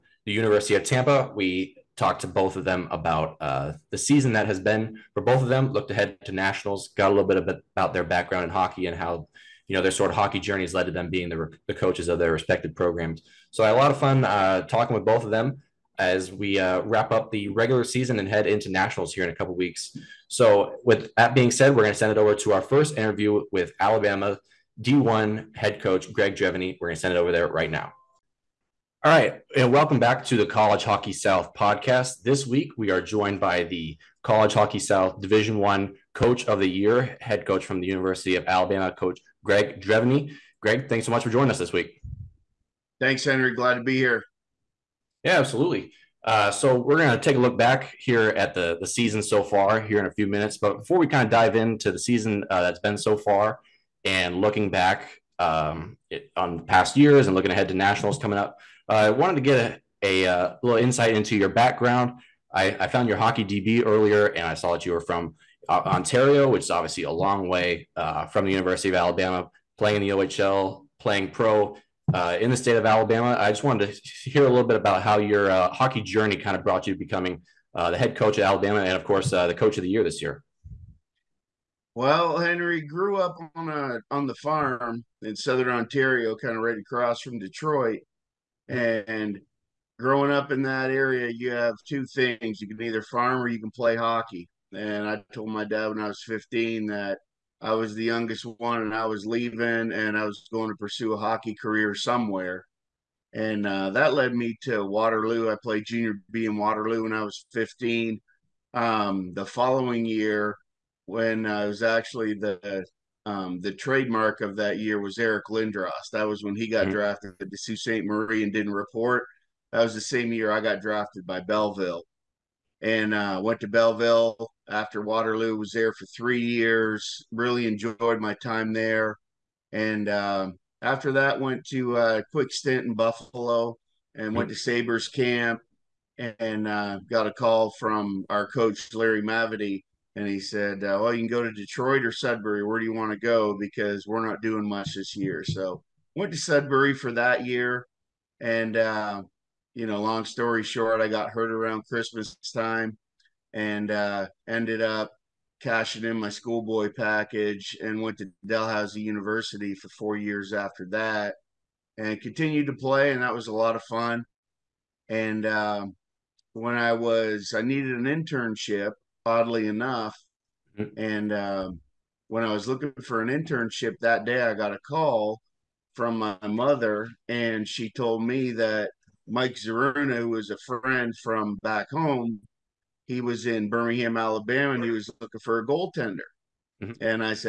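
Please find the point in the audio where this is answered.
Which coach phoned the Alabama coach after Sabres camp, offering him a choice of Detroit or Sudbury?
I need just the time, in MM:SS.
02:18.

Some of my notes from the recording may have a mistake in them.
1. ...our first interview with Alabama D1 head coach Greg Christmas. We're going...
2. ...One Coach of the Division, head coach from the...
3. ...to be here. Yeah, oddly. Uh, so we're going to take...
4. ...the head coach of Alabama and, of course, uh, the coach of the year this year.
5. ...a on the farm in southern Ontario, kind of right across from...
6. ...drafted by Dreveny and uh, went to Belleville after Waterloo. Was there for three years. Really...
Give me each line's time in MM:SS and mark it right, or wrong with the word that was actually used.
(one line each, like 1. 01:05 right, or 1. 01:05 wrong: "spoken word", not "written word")
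1. 00:22 wrong: "Dreveny", not "Christmas"
2. 00:35 wrong: "Year", not "Division"
3. 00:43 wrong: "absolutely", not "oddly"
4. 01:17 right
5. 01:23 right
6. 02:00 wrong: "Belleville", not "Dreveny".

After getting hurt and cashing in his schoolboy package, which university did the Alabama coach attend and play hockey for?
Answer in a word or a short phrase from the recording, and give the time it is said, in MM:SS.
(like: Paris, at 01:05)
Dalhousie University, at 02:38.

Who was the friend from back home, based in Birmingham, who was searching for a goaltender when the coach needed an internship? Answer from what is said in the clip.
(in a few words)
Mike Zeruna.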